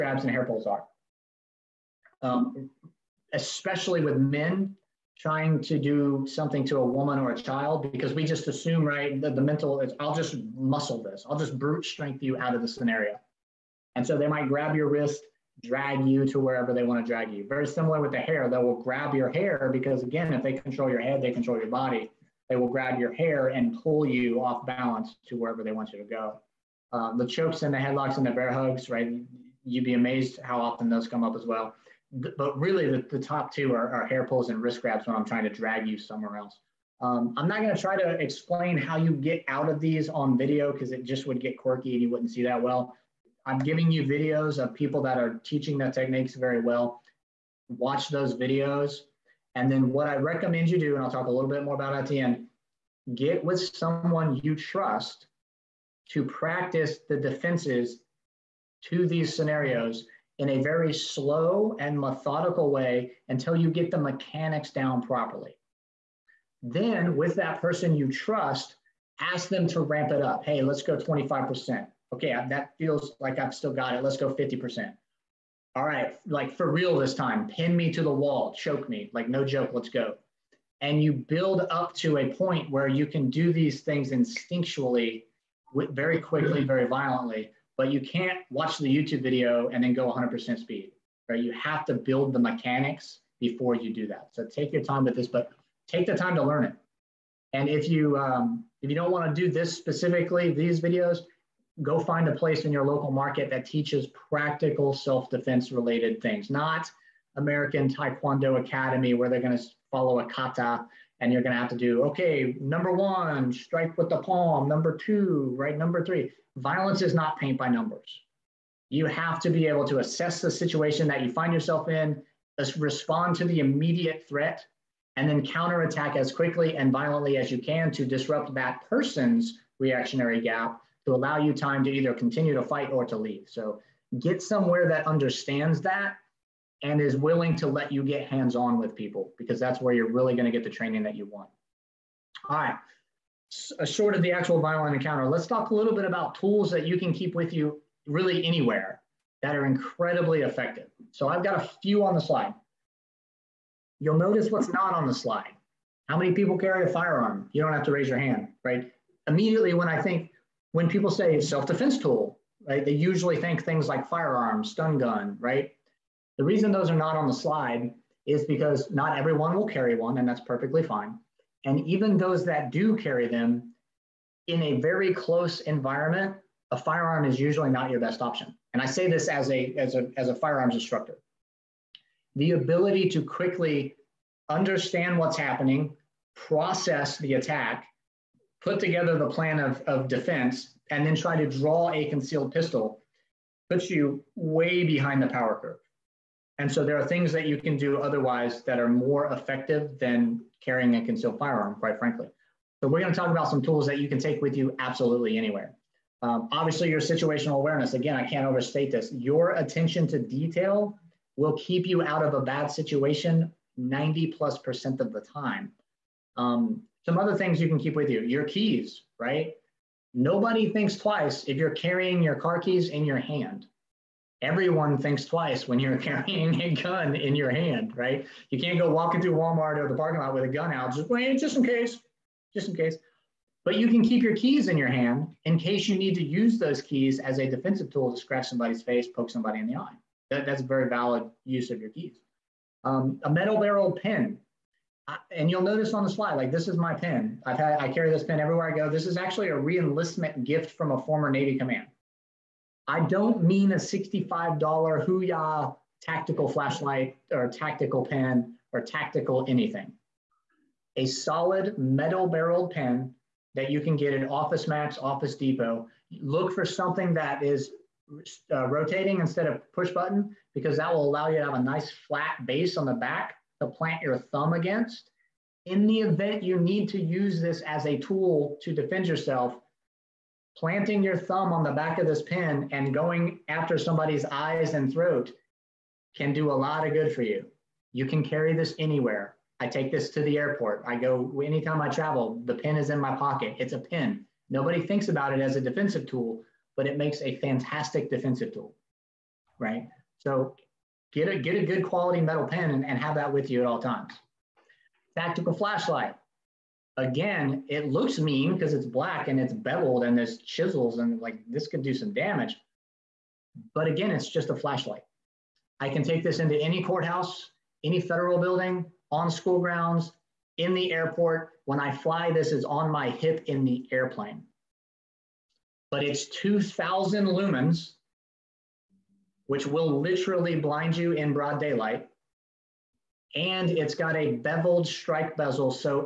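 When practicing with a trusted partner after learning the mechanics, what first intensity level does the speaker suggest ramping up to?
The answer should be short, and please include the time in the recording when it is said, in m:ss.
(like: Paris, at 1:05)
25%, at 1:10.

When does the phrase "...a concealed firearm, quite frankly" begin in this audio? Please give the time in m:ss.
3:20.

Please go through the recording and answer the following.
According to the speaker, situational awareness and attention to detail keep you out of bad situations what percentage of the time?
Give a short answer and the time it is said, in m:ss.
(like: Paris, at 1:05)
90 plus percent, at 3:33.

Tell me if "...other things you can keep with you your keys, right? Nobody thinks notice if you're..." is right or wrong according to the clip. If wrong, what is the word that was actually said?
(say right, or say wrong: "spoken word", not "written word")
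wrong: "twice", not "notice".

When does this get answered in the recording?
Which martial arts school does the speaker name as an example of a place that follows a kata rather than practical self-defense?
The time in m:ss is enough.
1:47.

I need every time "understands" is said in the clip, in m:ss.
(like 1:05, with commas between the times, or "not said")
2:15, 3:04.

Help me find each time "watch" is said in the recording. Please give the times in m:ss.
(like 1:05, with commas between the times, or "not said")
0:47, 1:28.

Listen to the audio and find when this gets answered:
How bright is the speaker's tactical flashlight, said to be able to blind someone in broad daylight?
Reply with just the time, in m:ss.
5:26.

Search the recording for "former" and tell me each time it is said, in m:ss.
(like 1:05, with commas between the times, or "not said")
4:11.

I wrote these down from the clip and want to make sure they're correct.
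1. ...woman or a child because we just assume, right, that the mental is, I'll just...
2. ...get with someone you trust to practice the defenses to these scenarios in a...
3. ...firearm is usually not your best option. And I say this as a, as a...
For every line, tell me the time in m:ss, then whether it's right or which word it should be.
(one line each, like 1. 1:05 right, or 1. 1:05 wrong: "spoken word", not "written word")
1. 0:06 right
2. 0:53 right
3. 2:56 right.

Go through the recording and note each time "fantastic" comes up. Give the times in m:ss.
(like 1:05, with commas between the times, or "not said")
4:57.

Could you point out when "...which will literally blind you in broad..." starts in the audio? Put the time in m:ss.
5:29.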